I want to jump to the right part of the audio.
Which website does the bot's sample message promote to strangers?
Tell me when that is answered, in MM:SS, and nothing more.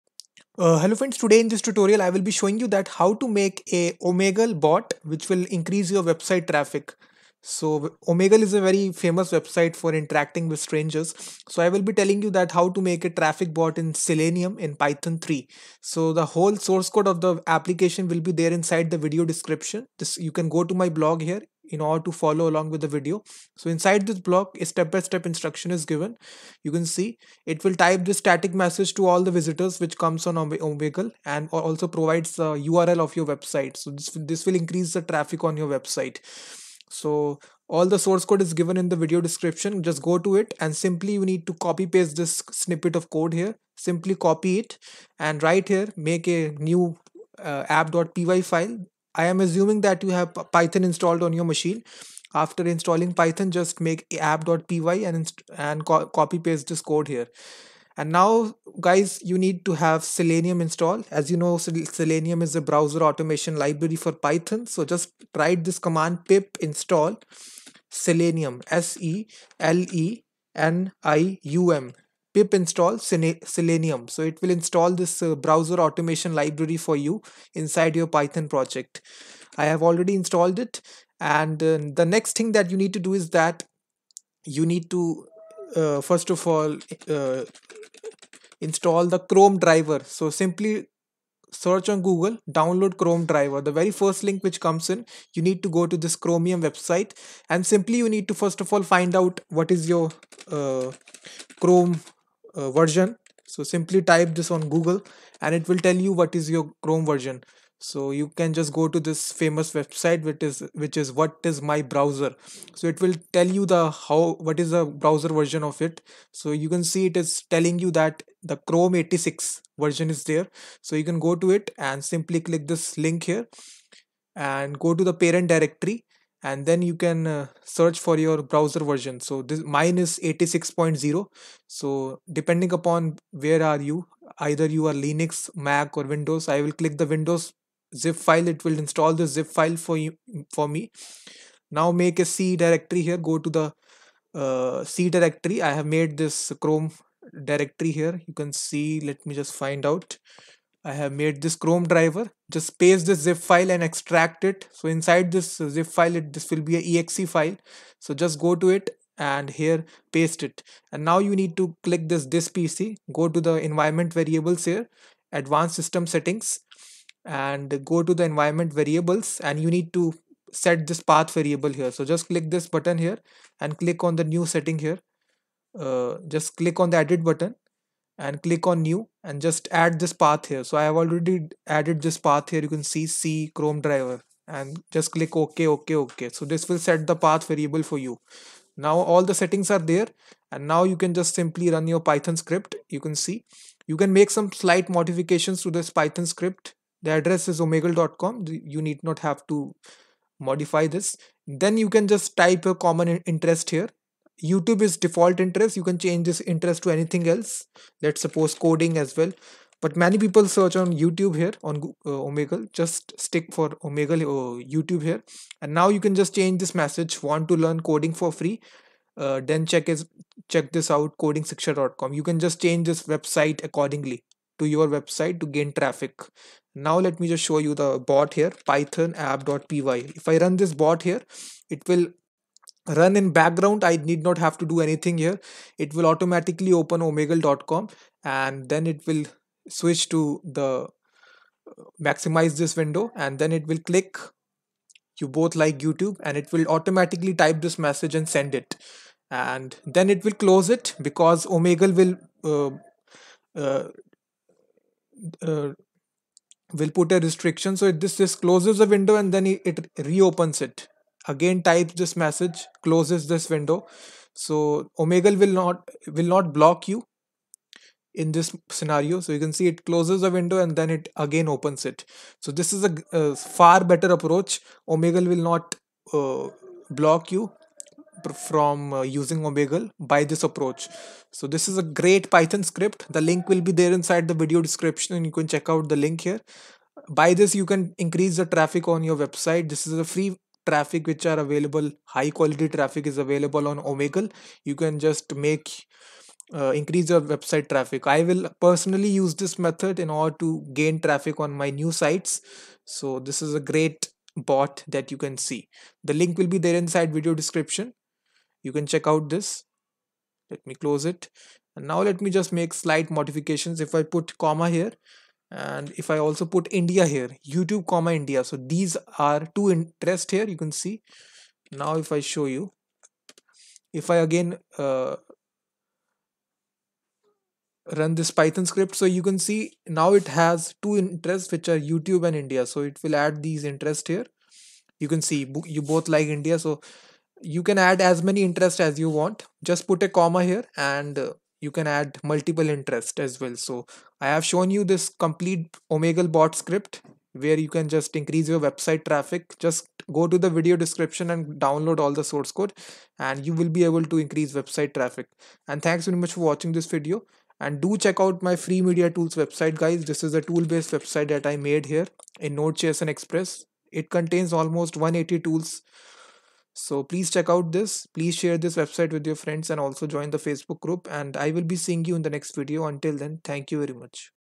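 03:41.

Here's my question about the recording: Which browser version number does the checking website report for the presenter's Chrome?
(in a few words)
86.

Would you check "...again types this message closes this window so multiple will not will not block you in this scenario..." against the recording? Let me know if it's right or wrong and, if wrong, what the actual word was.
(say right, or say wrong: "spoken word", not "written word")
wrong: "omegle", not "multiple".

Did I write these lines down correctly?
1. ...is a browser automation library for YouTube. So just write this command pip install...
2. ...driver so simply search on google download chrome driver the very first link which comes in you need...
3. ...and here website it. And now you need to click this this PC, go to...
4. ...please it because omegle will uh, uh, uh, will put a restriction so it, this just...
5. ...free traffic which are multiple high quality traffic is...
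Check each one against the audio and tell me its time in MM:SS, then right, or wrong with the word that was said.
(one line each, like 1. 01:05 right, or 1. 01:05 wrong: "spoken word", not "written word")
1. 01:02 wrong: "Python", not "YouTube"
2. 01:29 right
3. 02:39 wrong: "paste", not "website"
4. 04:10 wrong: "close", not "please"
5. 04:50 wrong: "available", not "multiple".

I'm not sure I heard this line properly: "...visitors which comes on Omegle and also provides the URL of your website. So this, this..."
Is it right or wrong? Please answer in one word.
right.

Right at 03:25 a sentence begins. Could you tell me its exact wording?
You can change this interest to anything else.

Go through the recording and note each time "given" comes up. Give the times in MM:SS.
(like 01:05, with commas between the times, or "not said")
00:25, 00:38.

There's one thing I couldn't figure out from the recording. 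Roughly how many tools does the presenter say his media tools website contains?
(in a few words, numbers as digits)
180.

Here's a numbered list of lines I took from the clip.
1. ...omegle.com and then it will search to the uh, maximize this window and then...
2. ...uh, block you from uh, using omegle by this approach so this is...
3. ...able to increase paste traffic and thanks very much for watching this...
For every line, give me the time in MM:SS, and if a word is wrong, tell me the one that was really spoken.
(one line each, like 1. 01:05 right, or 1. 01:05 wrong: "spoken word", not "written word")
1. 03:57 wrong: "switch", not "search"
2. 04:36 right
3. 05:53 wrong: "website", not "paste".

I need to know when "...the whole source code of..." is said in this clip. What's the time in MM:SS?
00:16.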